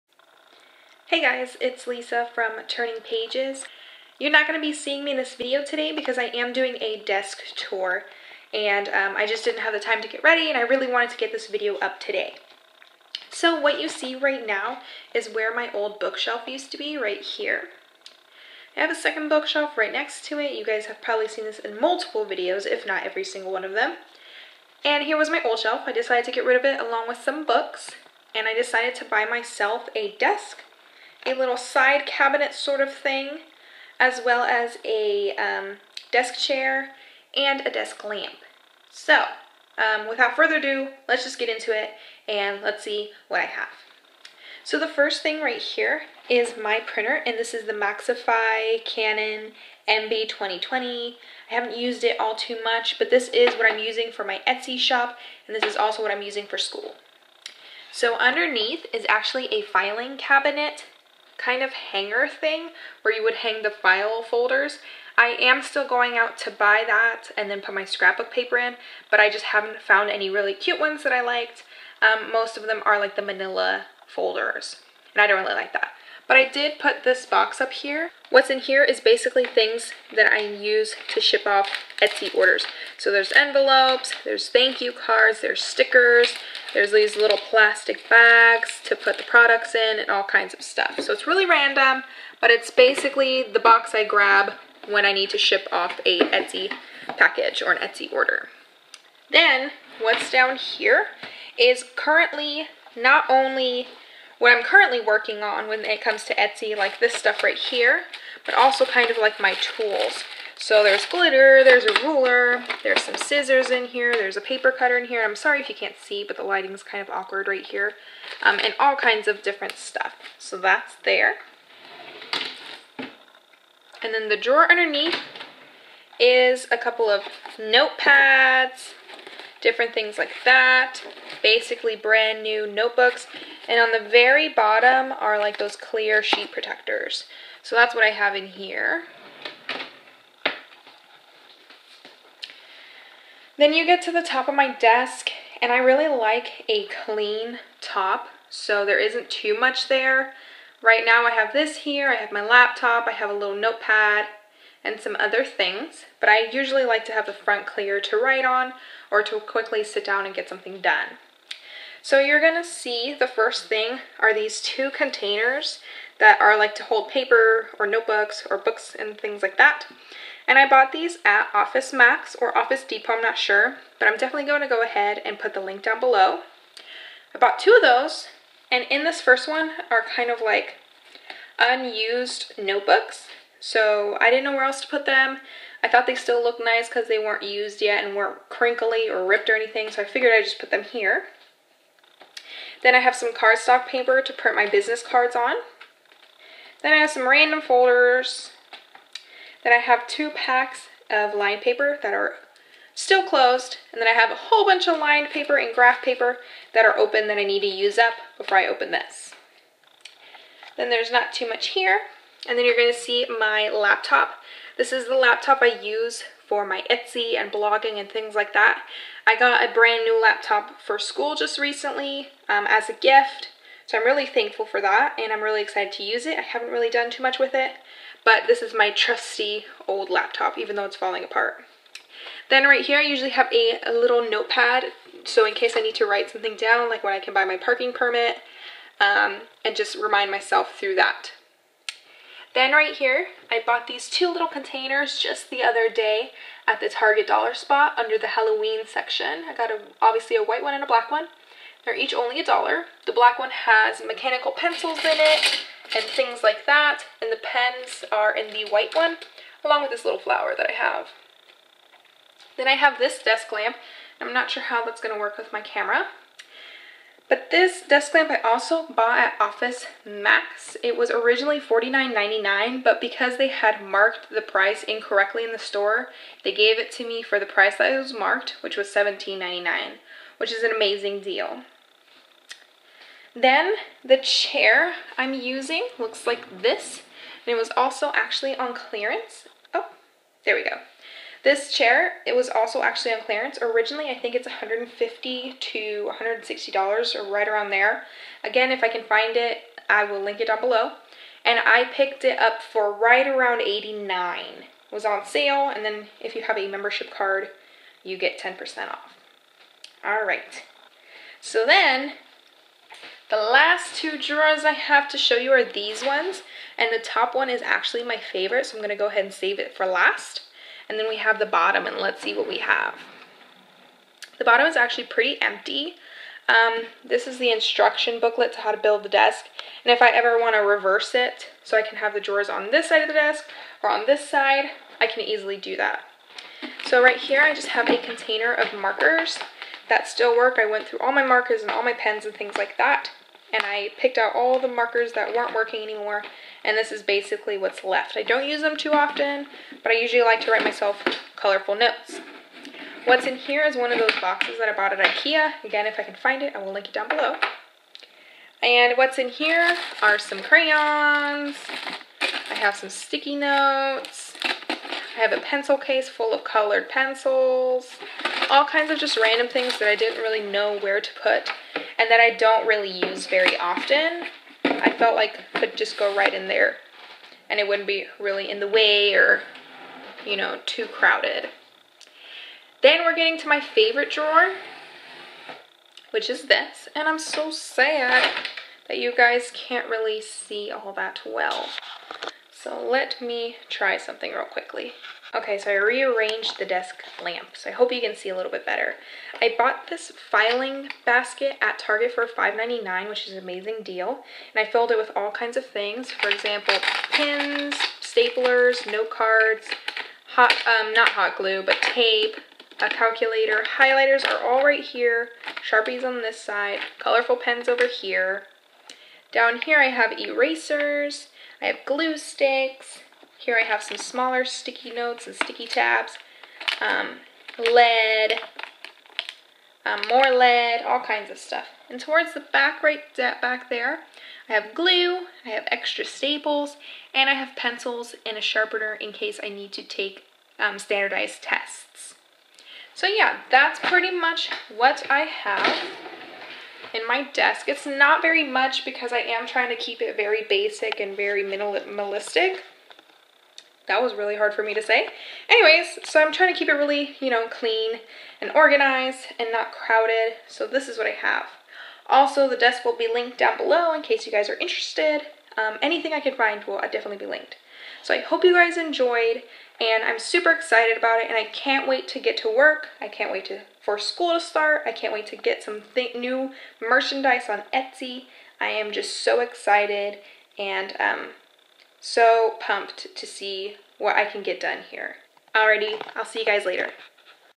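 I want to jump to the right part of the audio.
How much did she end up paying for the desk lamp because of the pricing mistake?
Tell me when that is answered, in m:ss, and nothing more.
4:38.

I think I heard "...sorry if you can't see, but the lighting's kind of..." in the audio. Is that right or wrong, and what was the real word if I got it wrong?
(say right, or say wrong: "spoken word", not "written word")
right.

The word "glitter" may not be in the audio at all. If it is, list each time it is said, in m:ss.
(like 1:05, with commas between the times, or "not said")
1:51.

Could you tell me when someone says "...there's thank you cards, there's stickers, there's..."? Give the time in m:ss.
1:24.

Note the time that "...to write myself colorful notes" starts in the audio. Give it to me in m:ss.
5:50.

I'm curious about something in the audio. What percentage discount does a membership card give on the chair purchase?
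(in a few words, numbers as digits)
10%.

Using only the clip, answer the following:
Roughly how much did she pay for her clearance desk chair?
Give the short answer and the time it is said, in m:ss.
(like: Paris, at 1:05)
About $89, at 5:02.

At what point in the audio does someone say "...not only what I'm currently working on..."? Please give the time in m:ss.
1:42.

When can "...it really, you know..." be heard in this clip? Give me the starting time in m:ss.
7:36.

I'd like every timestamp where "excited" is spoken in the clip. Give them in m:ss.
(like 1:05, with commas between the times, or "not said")
3:45, 7:50, 7:59.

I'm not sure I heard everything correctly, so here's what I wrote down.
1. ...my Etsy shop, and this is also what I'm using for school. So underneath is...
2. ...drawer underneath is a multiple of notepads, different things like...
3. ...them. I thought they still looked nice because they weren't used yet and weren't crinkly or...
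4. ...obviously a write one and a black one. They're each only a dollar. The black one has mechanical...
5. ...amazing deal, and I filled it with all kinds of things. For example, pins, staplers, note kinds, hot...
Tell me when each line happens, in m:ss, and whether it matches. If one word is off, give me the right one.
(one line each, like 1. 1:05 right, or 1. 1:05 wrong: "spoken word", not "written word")
1. 0:54 right
2. 2:04 wrong: "couple", not "multiple"
3. 3:05 right
4. 4:10 wrong: "white", not "write"
5. 6:43 wrong: "cards", not "kinds".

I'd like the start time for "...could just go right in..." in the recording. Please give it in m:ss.
6:15.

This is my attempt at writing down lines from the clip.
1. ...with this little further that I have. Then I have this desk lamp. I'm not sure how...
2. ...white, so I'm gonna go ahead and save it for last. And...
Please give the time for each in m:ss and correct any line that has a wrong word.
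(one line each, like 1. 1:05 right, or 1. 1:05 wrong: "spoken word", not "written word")
1. 4:19 wrong: "flower", not "further"
2. 5:18 wrong: "favorite", not "white".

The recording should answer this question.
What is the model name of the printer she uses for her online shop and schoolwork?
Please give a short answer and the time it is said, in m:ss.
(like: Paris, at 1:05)
Maxify Canon MB 2020, at 0:47.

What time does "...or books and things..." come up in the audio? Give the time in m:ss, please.
2:48.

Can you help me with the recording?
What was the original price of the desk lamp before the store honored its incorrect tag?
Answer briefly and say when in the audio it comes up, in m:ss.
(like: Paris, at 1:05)
$49.99, at 4:31.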